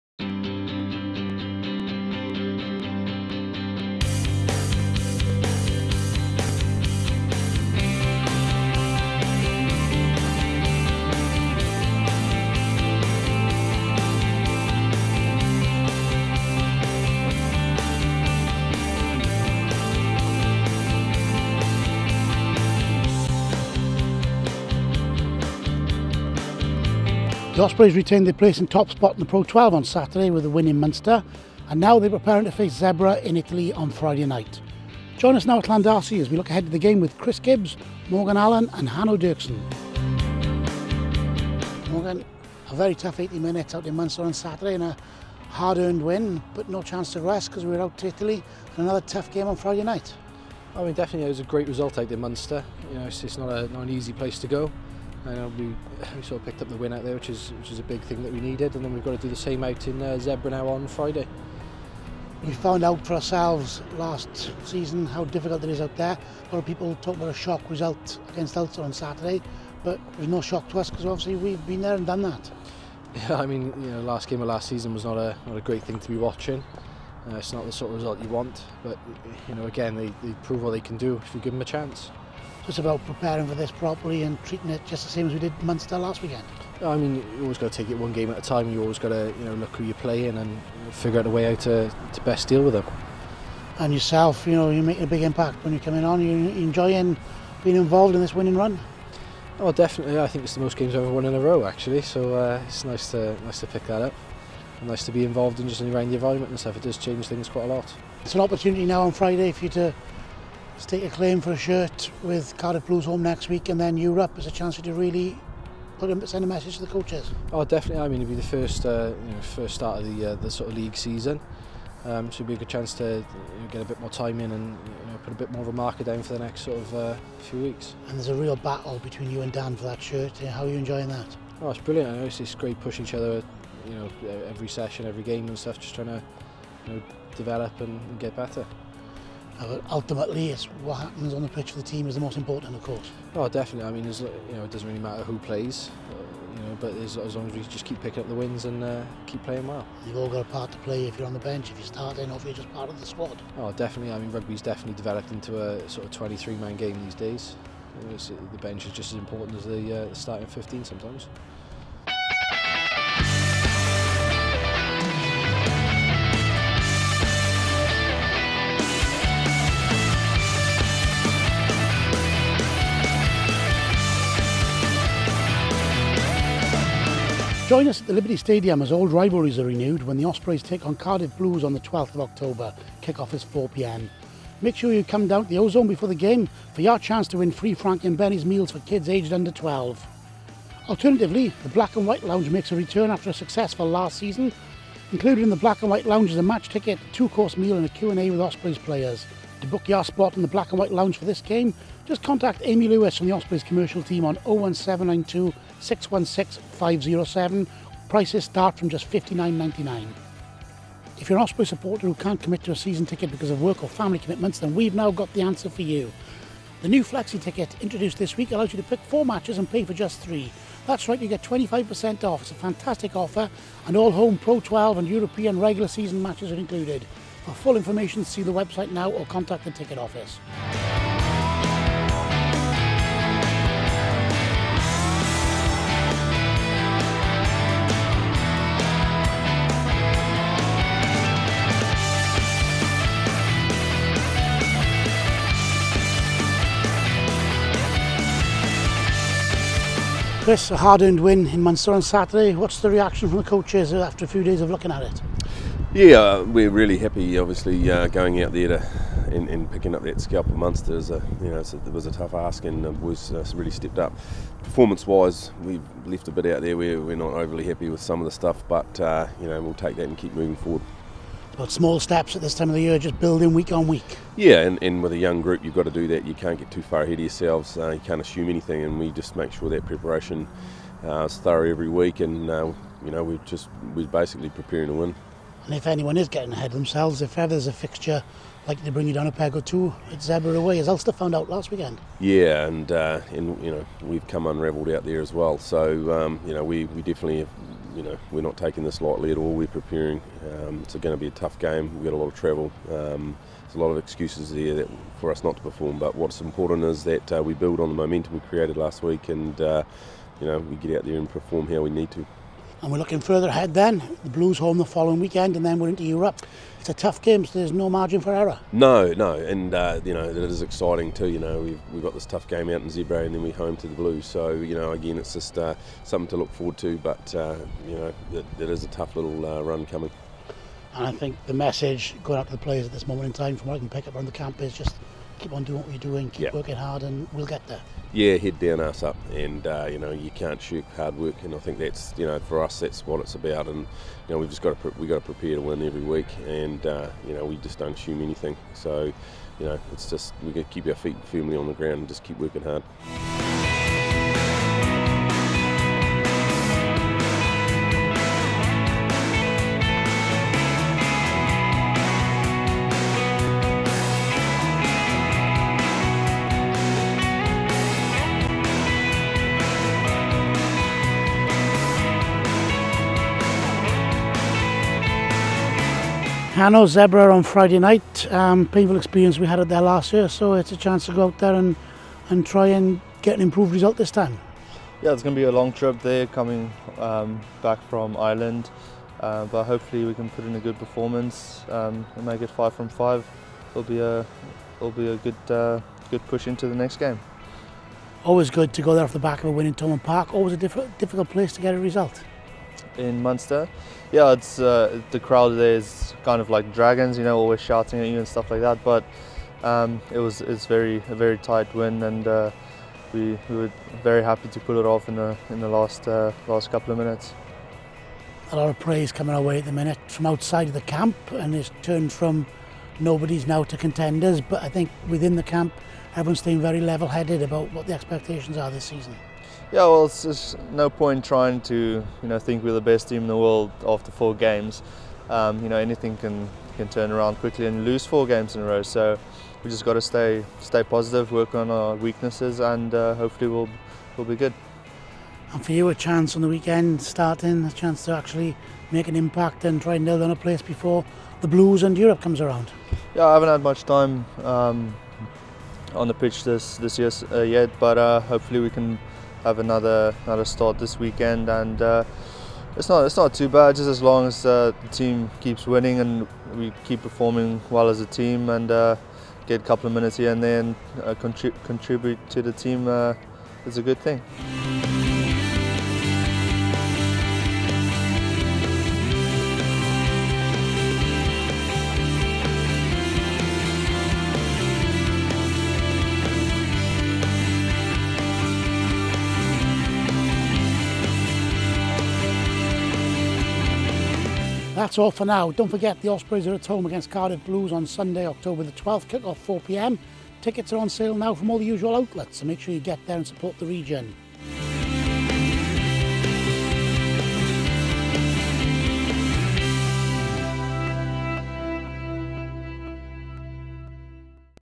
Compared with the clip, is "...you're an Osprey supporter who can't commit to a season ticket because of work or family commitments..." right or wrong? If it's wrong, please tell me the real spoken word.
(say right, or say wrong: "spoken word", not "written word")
right.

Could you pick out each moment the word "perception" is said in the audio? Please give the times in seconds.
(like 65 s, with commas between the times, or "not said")
not said.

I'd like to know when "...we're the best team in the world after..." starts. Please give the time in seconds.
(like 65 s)
432 s.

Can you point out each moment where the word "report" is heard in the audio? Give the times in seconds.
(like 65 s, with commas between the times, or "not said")
not said.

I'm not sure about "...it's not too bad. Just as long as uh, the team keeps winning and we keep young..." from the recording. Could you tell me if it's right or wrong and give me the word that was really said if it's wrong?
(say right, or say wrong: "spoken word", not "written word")
wrong: "performing", not "young".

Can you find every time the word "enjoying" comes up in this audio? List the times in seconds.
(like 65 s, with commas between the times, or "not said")
96 s, 130 s.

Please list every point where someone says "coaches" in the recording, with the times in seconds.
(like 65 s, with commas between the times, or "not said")
116 s, 253 s.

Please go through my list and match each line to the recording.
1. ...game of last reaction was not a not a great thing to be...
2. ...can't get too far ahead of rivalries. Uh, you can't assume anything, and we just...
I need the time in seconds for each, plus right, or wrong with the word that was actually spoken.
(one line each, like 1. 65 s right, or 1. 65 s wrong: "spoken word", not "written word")
1. 74 s wrong: "season", not "reaction"
2. 276 s wrong: "yourselves", not "rivalries".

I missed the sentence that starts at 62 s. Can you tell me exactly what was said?
We found out for ourselves last season how difficult it is out there.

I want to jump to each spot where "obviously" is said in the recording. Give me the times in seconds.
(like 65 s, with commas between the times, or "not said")
71 s, 257 s.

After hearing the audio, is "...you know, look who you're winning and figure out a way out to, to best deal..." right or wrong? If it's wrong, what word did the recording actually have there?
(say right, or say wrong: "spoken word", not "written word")
wrong: "playing", not "winning".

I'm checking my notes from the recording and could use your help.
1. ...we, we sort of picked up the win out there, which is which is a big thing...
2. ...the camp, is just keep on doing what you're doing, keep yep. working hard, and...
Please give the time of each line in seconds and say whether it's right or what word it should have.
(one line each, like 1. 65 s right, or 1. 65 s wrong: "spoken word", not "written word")
1. 55 s right
2. 334 s right.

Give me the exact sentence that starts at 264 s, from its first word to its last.
Performance-wise, we left a bit out there.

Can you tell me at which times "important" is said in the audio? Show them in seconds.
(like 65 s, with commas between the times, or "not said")
142 s, 159 s, 306 s.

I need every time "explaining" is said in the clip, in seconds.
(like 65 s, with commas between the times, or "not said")
not said.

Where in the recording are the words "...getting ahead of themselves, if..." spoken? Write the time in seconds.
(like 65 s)
286 s.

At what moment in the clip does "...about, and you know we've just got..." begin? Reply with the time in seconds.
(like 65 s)
343 s.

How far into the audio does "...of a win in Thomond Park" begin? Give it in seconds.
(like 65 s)
399 s.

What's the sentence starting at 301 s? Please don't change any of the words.
We've got a lot of travel.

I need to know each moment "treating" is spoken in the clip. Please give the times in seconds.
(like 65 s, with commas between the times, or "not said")
84 s.